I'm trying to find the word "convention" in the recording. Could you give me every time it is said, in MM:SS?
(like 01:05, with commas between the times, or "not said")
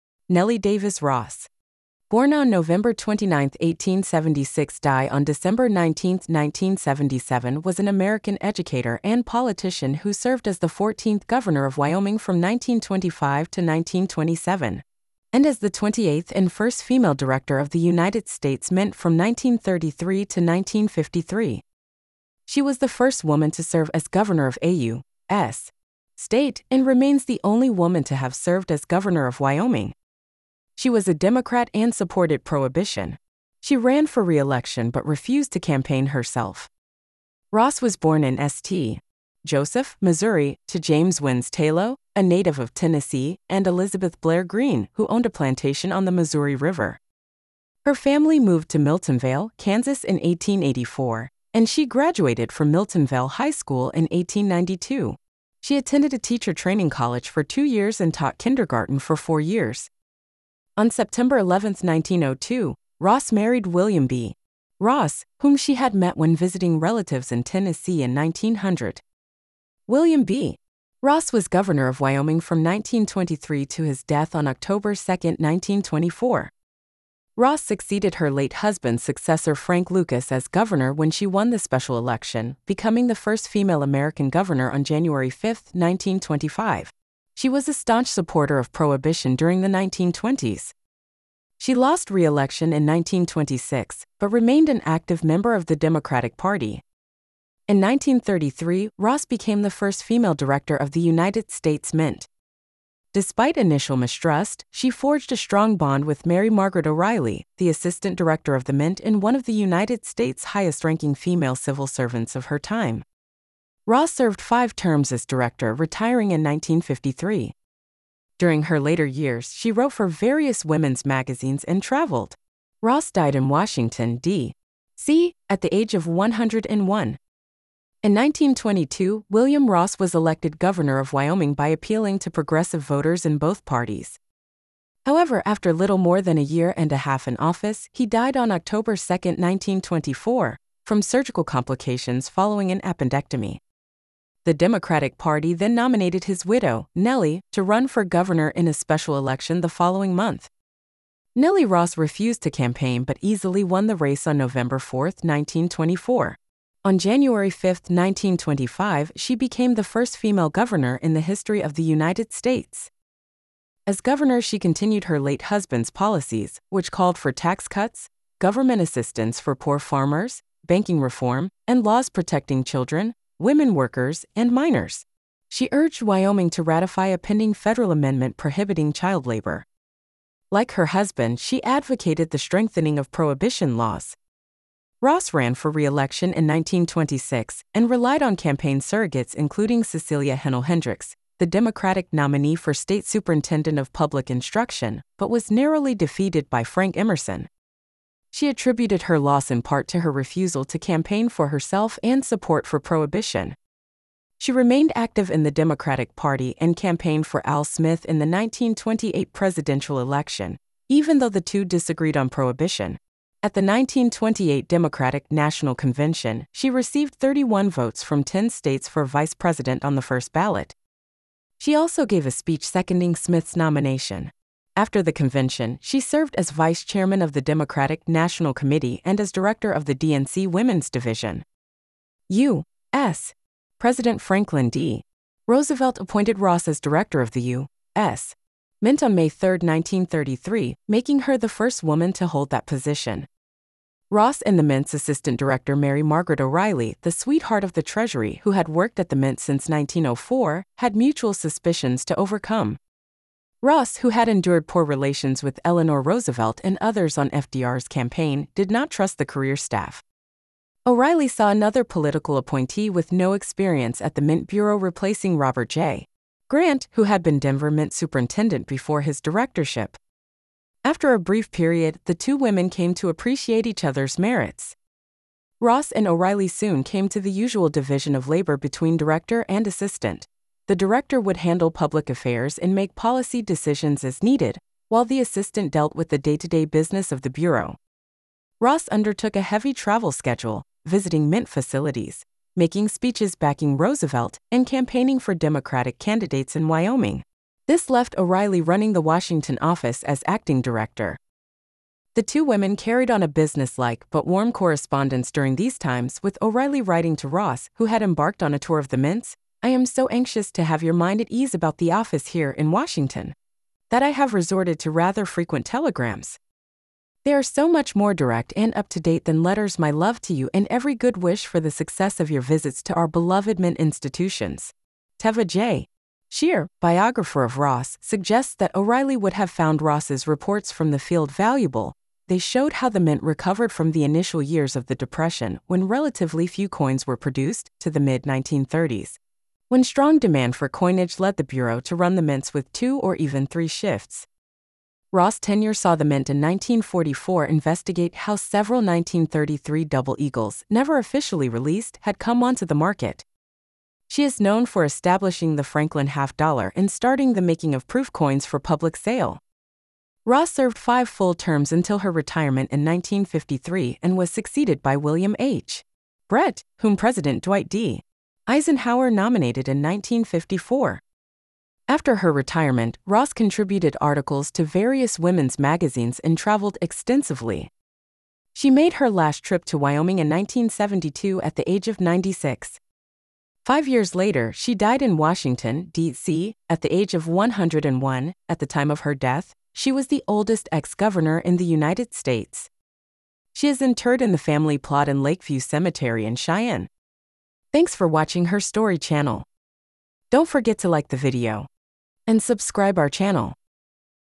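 03:35, 03:45.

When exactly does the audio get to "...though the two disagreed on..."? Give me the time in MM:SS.
03:31.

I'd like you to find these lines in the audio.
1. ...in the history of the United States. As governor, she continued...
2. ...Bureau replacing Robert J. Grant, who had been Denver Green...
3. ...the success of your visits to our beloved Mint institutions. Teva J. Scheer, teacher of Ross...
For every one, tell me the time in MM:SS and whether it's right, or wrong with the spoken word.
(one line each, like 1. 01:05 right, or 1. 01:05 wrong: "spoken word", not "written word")
1. 02:41 right
2. 04:24 wrong: "Mint", not "Green"
3. 05:21 wrong: "biographer", not "teacher".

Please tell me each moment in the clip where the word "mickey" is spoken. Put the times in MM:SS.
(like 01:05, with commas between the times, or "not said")
not said.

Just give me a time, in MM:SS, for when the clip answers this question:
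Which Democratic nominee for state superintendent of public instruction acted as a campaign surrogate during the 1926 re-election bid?
03:09.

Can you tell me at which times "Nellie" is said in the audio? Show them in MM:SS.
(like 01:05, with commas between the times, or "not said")
00:00, 02:26, 02:31.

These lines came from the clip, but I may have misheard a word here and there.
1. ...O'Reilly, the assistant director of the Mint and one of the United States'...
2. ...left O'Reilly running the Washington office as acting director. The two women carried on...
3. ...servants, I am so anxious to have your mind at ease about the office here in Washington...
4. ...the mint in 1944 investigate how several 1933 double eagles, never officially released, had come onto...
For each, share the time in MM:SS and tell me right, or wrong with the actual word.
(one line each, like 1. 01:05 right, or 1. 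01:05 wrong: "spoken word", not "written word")
1. 01:46 right
2. 04:57 right
3. 05:08 wrong: "mints", not "servants"
4. 05:45 right.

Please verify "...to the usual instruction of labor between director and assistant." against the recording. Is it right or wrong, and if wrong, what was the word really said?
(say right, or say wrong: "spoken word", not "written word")
wrong: "division", not "instruction".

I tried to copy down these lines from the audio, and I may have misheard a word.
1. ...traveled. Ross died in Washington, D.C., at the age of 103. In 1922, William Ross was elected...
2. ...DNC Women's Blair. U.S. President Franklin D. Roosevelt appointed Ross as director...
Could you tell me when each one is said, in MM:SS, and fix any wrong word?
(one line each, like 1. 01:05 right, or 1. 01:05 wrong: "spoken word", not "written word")
1. 02:01 wrong: "101", not "103"
2. 03:49 wrong: "Division", not "Blair".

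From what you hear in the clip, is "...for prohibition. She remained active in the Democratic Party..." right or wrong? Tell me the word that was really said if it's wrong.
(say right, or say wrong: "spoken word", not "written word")
right.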